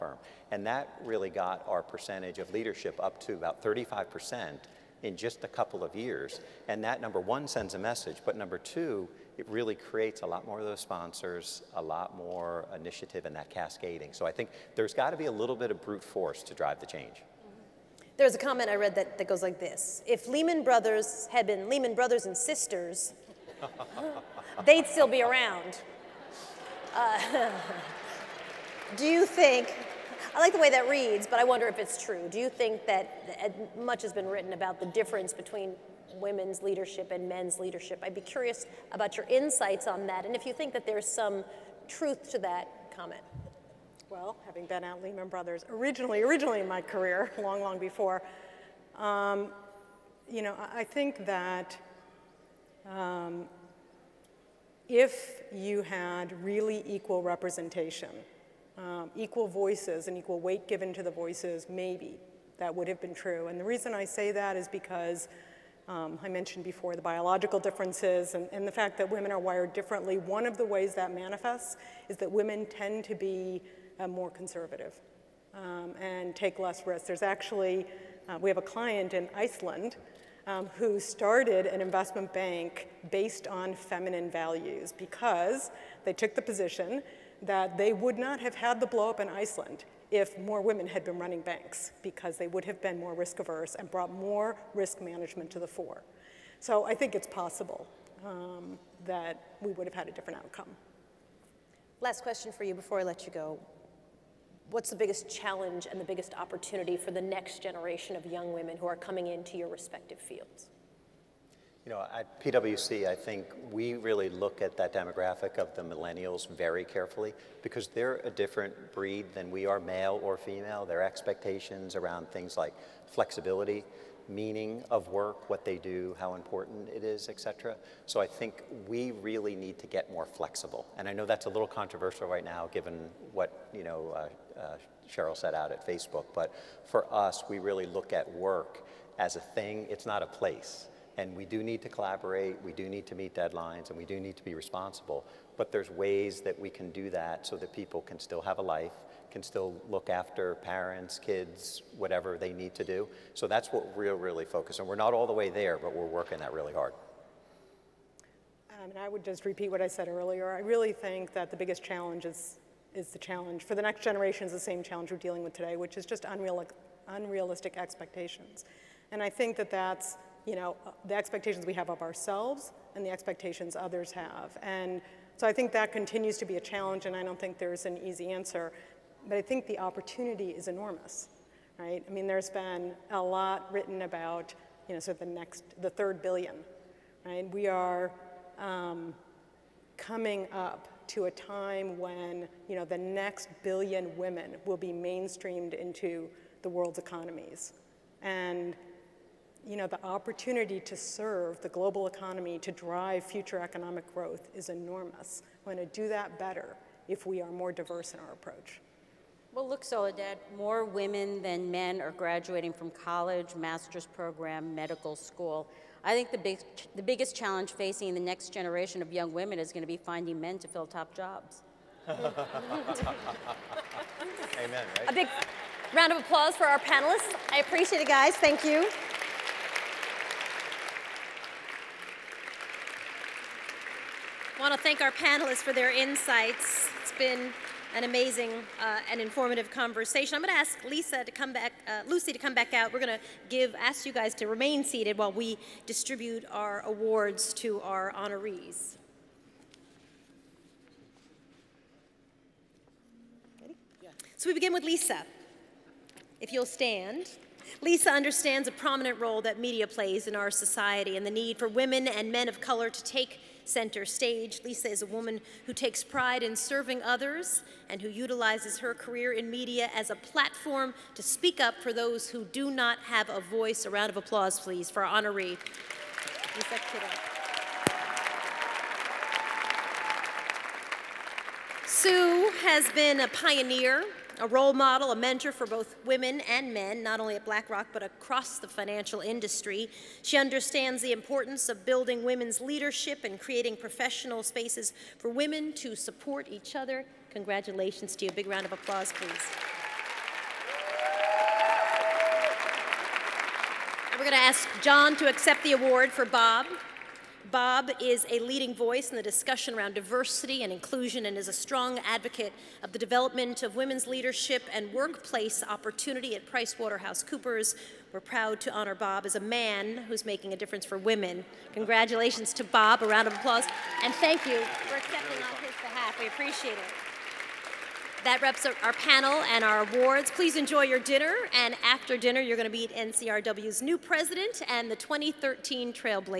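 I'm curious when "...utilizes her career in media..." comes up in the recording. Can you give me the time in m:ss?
4:28.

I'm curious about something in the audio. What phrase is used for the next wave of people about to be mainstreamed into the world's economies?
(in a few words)
The third billion.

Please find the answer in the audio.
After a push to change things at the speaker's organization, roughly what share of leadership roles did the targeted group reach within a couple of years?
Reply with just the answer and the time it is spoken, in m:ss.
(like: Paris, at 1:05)
35%, at 0:03.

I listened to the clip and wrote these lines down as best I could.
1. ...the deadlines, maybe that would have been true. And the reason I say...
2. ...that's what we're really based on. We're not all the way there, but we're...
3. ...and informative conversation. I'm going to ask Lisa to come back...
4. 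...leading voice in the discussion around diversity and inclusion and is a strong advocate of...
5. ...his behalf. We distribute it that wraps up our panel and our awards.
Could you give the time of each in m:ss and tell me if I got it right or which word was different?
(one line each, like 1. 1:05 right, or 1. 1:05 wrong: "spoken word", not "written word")
1. 1:01 wrong: "voices", not "deadlines"
2. 2:33 wrong: "focused", not "based"
3. 3:59 right
4. 5:08 right
5. 5:25 wrong: "appreciate", not "distribute".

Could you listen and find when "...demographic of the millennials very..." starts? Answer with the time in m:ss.
1:54.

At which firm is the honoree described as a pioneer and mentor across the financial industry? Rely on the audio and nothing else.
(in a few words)
BlackRock.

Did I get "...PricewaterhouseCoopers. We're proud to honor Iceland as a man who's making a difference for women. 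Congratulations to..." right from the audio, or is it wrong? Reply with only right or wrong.
wrong.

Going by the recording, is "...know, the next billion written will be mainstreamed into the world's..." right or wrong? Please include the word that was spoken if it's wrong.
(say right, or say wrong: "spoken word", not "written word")
wrong: "women", not "written".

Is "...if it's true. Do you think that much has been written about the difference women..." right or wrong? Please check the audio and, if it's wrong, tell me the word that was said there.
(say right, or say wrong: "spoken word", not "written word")
wrong: "between", not "women".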